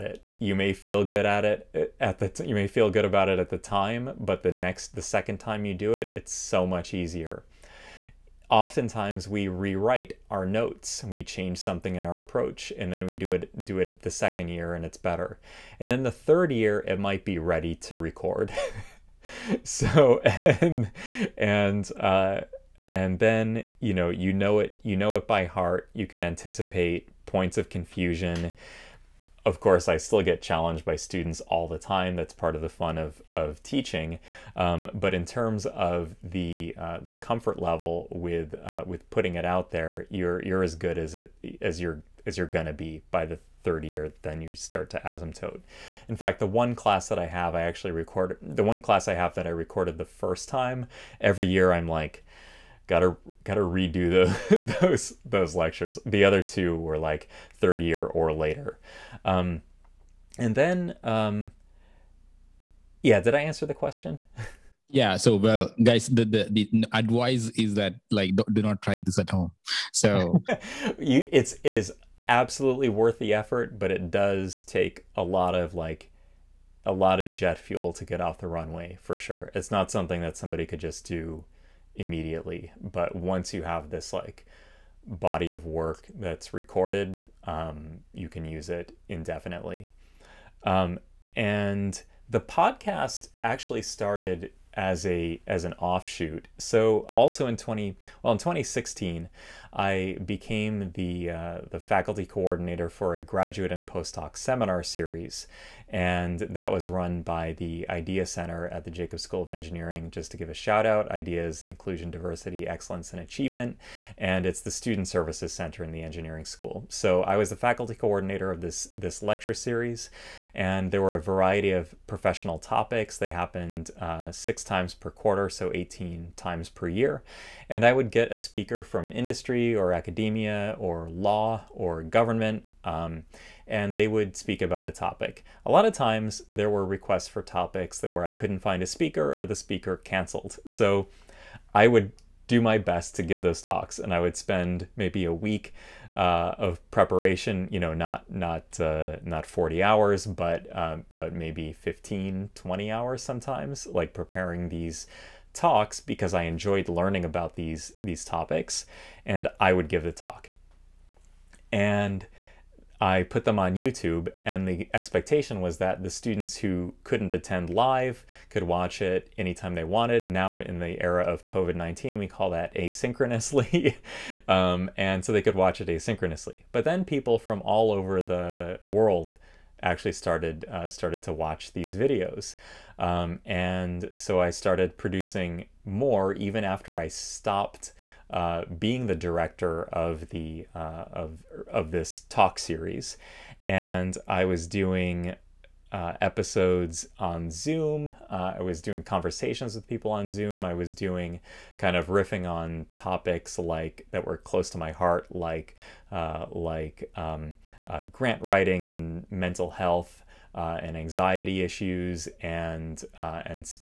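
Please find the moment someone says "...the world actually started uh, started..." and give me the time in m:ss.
2:58.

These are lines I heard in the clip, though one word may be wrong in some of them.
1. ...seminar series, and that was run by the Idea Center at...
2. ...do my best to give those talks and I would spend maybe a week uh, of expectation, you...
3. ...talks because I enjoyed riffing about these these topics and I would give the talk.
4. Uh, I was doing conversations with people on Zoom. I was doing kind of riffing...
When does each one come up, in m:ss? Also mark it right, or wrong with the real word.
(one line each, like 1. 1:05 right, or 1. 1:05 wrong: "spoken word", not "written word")
1. 1:44 right
2. 2:22 wrong: "preparation", not "expectation"
3. 2:35 wrong: "learning", not "riffing"
4. 3:18 right.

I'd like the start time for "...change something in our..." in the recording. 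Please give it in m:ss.
0:11.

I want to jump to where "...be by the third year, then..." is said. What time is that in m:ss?
0:42.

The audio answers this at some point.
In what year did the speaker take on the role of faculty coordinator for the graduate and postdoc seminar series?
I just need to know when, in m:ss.
1:38.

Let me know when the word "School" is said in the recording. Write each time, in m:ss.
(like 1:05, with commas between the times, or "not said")
1:49, 1:56.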